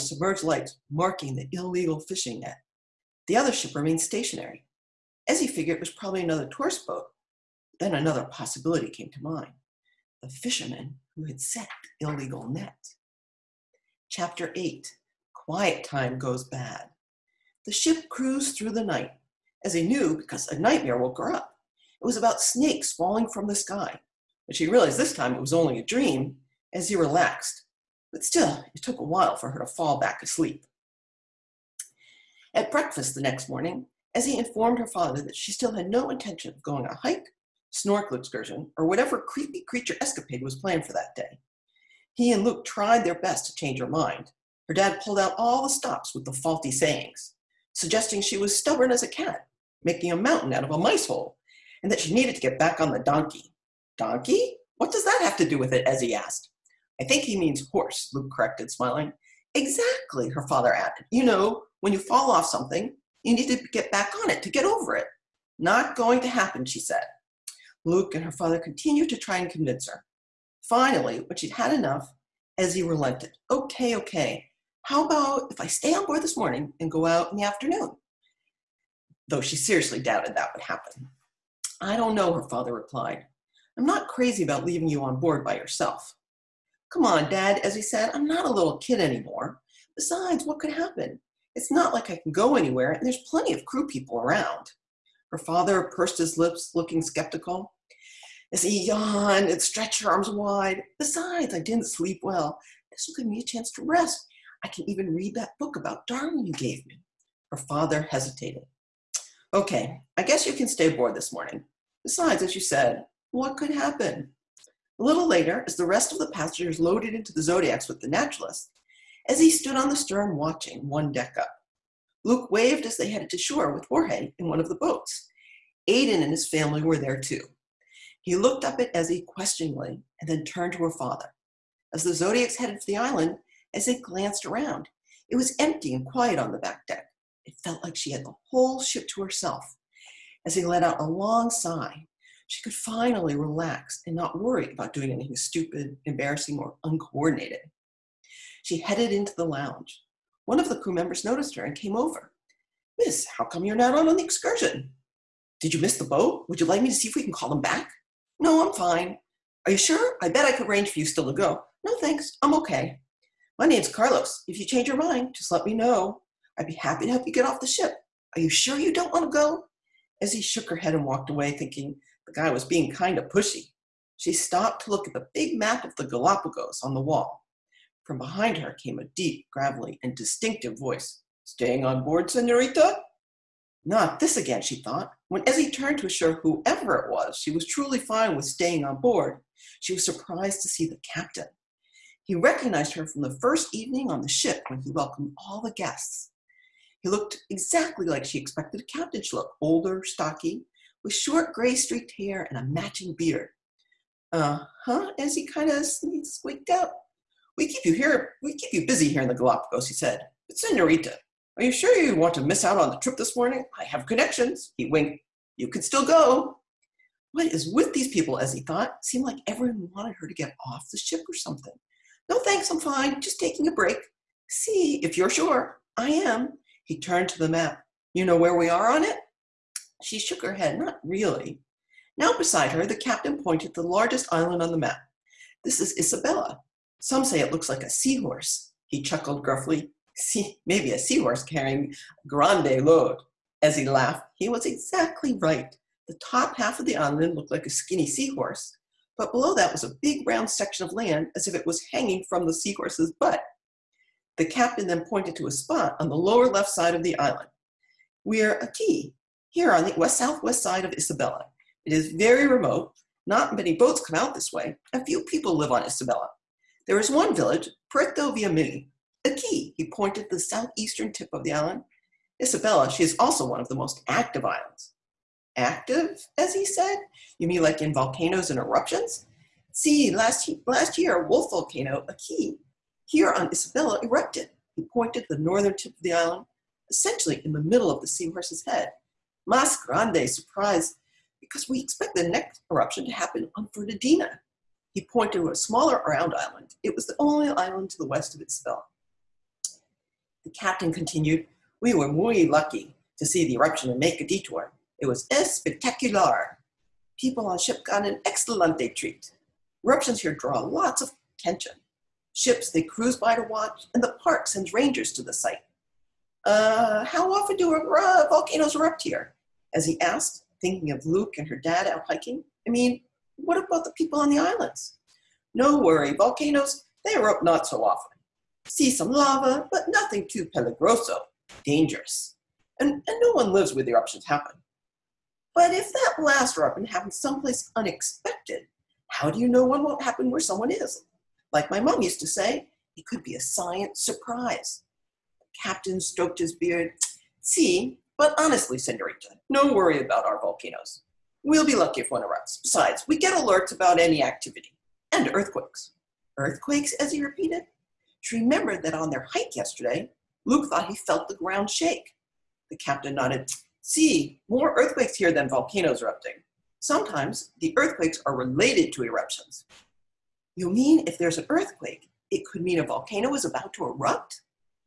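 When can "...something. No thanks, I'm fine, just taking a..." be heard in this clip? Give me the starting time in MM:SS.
03:41.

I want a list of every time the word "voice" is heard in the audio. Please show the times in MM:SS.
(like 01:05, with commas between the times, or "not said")
03:00.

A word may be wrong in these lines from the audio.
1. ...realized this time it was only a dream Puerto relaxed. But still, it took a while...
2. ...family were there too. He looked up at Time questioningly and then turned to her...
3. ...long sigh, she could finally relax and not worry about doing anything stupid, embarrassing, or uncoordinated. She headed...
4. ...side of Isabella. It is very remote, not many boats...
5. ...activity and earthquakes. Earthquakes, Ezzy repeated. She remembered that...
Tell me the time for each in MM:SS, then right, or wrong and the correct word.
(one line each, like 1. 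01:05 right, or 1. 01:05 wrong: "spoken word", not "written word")
1. 00:24 wrong: "Ezzy", not "Puerto"
2. 02:06 wrong: "Ezzy", not "Time"
3. 02:21 right
4. 04:20 right
5. 05:54 right.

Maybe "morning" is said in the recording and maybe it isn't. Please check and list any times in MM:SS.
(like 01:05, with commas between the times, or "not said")
00:33, 01:16, 01:51, 03:33.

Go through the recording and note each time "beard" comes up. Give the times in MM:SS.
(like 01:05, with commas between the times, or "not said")
03:23, 05:46.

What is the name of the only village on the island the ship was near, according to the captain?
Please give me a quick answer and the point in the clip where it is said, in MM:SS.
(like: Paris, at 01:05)
Puerto Villamil, at 04:27.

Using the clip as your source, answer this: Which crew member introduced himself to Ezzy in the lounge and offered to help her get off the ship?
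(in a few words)
Carlos.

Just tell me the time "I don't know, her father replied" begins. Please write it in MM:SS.
01:21.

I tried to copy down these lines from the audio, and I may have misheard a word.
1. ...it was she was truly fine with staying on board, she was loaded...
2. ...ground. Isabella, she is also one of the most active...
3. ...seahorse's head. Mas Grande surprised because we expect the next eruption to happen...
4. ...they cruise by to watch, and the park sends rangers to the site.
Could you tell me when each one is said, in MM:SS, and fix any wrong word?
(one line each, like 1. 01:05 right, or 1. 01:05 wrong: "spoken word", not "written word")
1. 03:06 wrong: "surprised", not "loaded"
2. 04:31 wrong: "island", not "ground"
3. 04:48 right
4. 05:12 right.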